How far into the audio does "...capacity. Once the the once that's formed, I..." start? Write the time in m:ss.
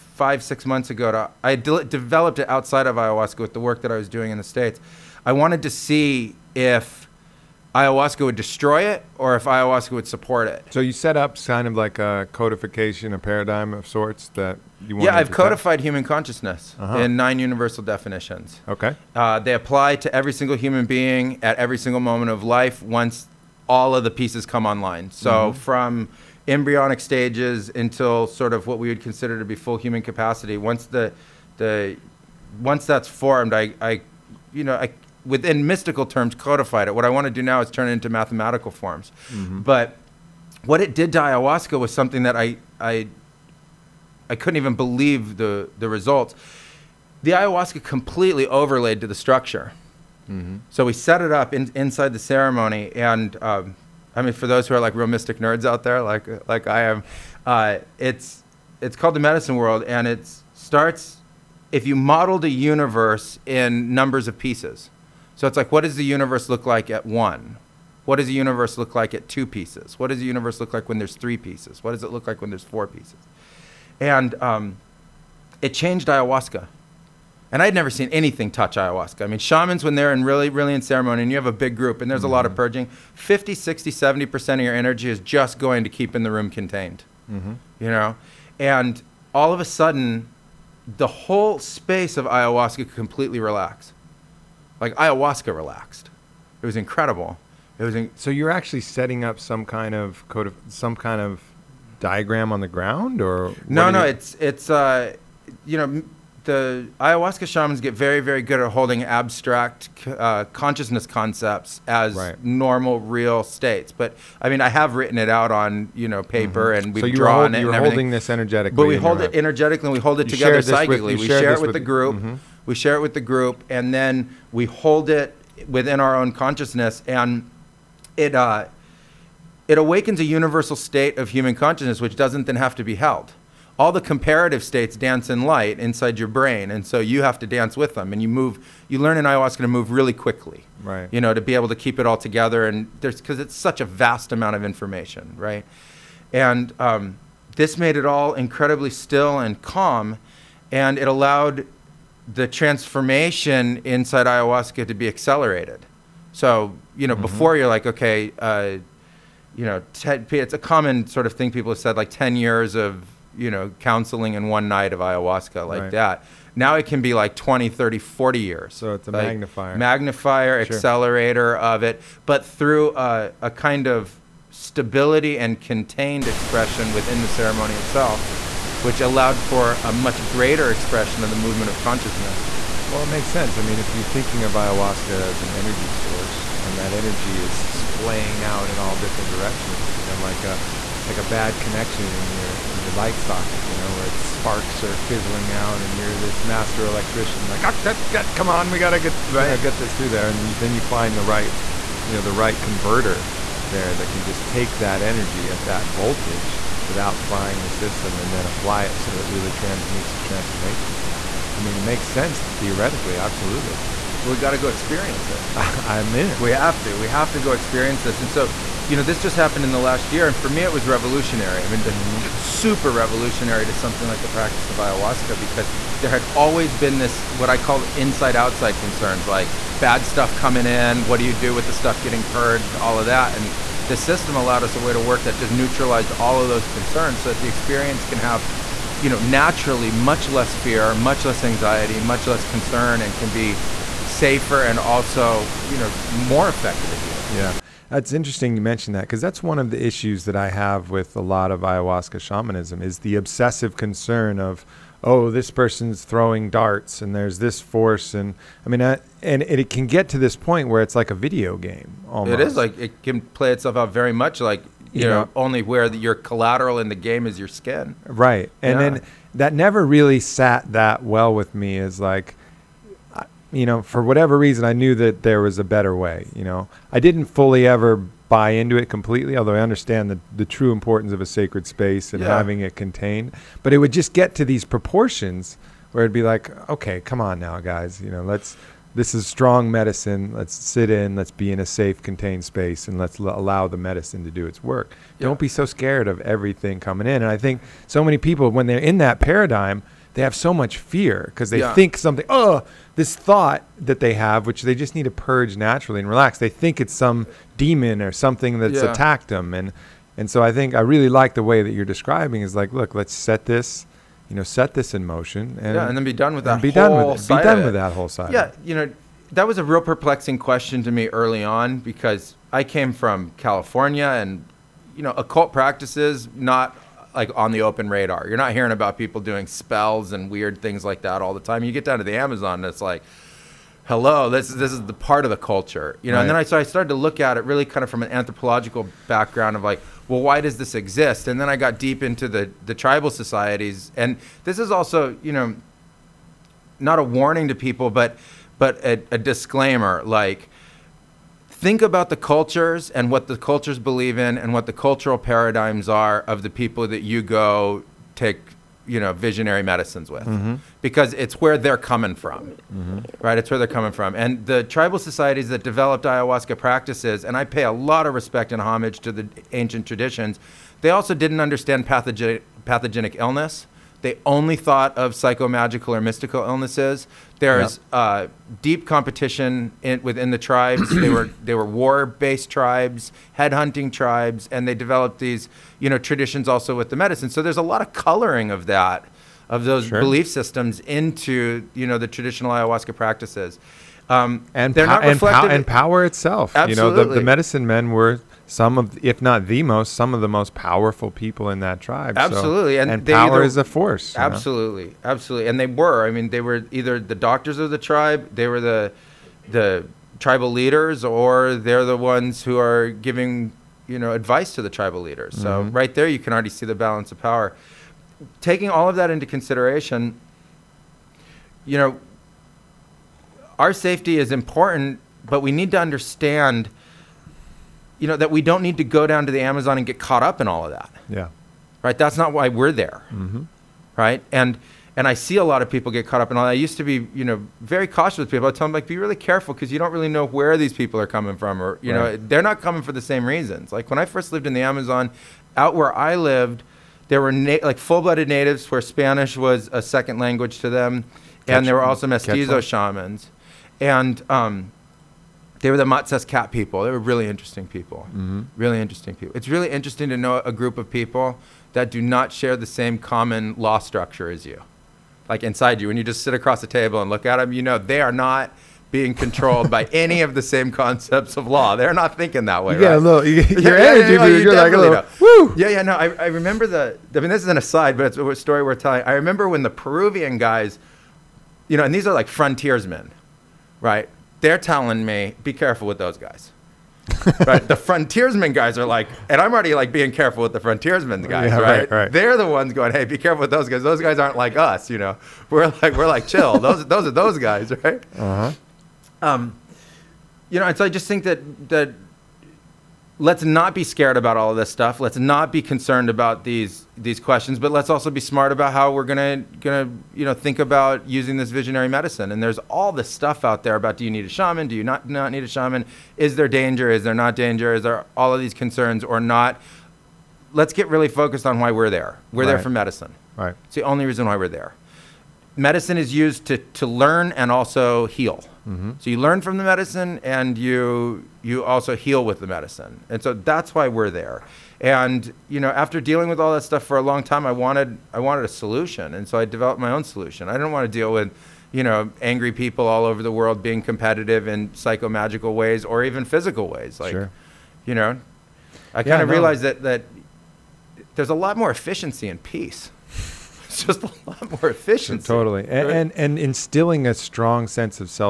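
0:30.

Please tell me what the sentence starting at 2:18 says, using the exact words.
You learn in ayahuasca to move really quickly, right?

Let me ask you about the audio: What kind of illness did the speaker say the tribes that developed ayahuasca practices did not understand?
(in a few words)
pathogenic illness.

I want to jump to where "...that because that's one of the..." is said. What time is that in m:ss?
4:08.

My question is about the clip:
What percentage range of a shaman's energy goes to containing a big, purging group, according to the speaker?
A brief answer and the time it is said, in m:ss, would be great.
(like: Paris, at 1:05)
50 to 70%, at 1:22.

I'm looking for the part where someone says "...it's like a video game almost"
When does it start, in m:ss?
4:20.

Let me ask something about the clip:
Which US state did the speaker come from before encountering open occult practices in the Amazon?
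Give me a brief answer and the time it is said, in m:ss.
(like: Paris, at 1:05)
California, at 5:23.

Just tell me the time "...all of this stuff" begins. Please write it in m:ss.
8:24.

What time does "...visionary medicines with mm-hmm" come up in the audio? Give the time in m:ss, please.
5:59.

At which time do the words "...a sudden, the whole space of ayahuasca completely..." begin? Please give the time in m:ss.
1:29.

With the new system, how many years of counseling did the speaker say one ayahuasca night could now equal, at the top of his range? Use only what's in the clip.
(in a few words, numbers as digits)
40 years.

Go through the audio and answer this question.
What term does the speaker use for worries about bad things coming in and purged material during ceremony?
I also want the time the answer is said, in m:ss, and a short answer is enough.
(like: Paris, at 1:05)
inside-outside concerns, at 3:47.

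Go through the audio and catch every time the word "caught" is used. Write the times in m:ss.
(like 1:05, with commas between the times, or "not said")
7:09, 7:16.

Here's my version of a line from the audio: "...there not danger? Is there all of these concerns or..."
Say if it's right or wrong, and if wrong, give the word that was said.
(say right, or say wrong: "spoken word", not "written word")
right.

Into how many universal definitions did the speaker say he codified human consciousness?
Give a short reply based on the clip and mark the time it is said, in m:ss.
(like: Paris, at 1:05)
9, at 0:17.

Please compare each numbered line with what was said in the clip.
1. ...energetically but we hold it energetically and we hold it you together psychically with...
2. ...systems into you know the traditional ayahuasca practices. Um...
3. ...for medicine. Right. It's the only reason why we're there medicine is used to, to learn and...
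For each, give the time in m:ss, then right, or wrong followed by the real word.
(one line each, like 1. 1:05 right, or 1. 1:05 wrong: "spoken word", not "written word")
1. 1:58 right
2. 6:30 right
3. 8:42 right.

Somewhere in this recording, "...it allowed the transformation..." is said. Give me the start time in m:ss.
2:30.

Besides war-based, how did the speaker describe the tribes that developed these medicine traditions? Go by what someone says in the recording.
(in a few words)
headhunting tribes.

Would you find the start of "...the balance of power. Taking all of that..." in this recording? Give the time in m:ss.
6:56.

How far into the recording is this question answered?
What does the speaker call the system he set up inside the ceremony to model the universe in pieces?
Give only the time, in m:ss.
0:59.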